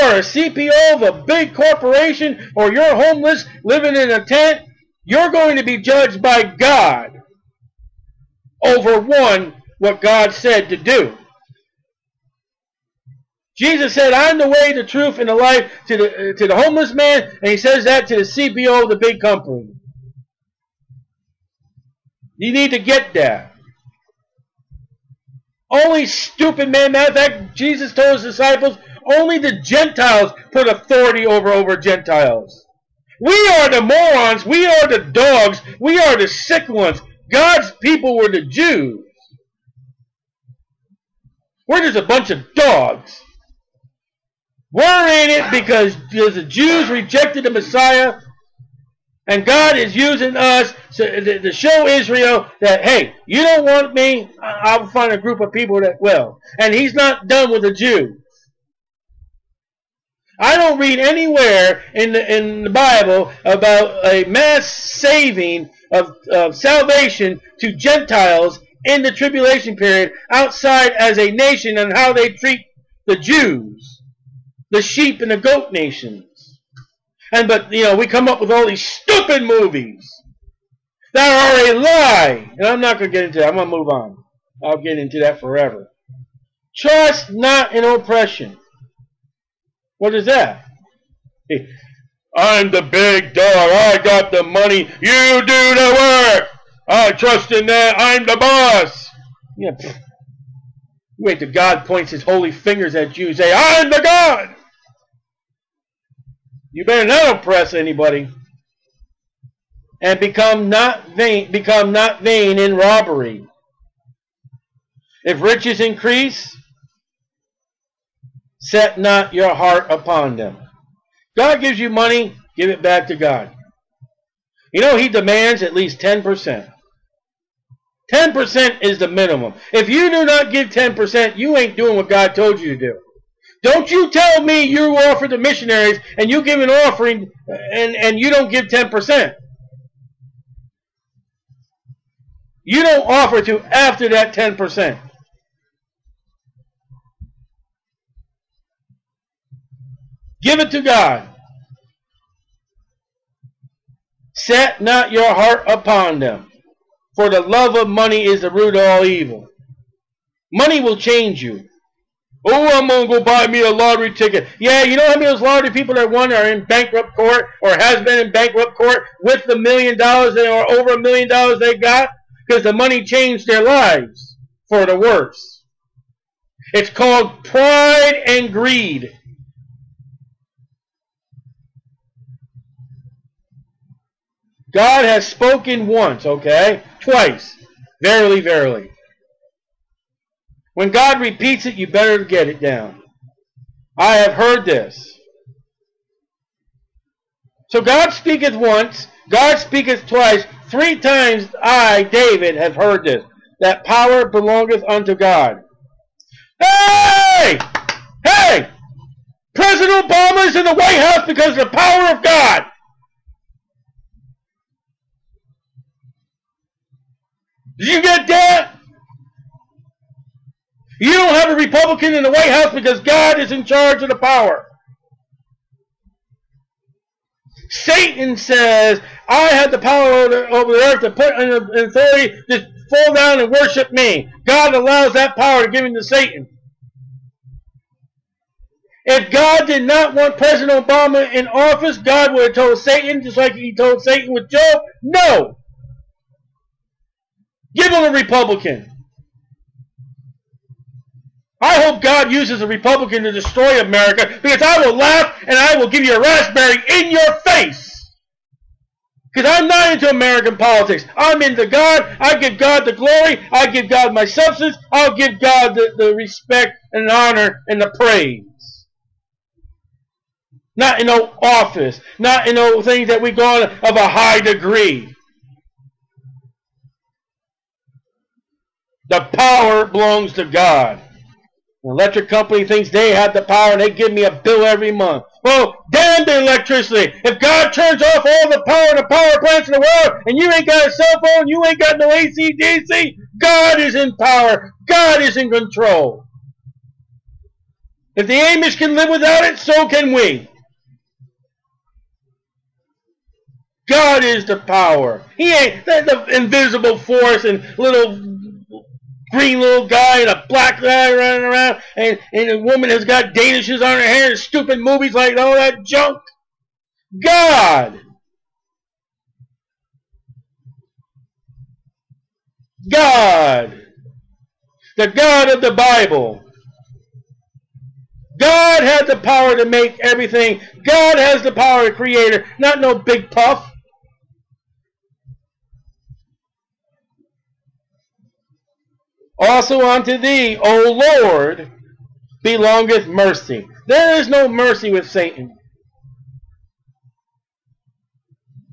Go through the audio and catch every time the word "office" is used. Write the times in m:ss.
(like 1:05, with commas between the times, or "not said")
4:01, 4:31.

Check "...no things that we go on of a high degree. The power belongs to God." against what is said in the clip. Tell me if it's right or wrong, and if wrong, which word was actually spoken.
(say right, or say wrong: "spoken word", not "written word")
right.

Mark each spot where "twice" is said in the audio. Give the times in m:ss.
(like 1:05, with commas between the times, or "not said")
3:07, 3:20.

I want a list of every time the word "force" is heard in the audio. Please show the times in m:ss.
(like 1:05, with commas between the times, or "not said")
5:06.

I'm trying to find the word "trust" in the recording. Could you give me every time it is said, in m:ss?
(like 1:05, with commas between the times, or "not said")
1:26, 1:37.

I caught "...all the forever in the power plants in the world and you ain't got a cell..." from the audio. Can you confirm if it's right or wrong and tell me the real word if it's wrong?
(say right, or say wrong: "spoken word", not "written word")
wrong: "power", not "forever".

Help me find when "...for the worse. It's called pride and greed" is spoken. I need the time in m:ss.
2:54.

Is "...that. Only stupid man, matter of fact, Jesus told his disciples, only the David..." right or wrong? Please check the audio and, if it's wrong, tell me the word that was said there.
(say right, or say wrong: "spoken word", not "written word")
wrong: "Gentiles", not "David".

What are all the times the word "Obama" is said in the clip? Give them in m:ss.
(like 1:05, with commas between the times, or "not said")
3:30, 4:00.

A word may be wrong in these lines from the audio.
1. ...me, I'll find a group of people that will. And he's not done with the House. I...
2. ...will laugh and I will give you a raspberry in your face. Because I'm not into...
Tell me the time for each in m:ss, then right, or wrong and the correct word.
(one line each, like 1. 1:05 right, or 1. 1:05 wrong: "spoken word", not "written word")
1. 0:53 wrong: "Jews", not "House"
2. 4:14 right.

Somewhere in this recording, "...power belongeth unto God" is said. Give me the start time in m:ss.
3:23.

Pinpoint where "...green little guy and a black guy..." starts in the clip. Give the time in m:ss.
5:09.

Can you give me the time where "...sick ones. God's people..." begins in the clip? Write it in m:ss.
0:36.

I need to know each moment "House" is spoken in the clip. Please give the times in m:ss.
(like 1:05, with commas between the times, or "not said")
3:31, 3:42.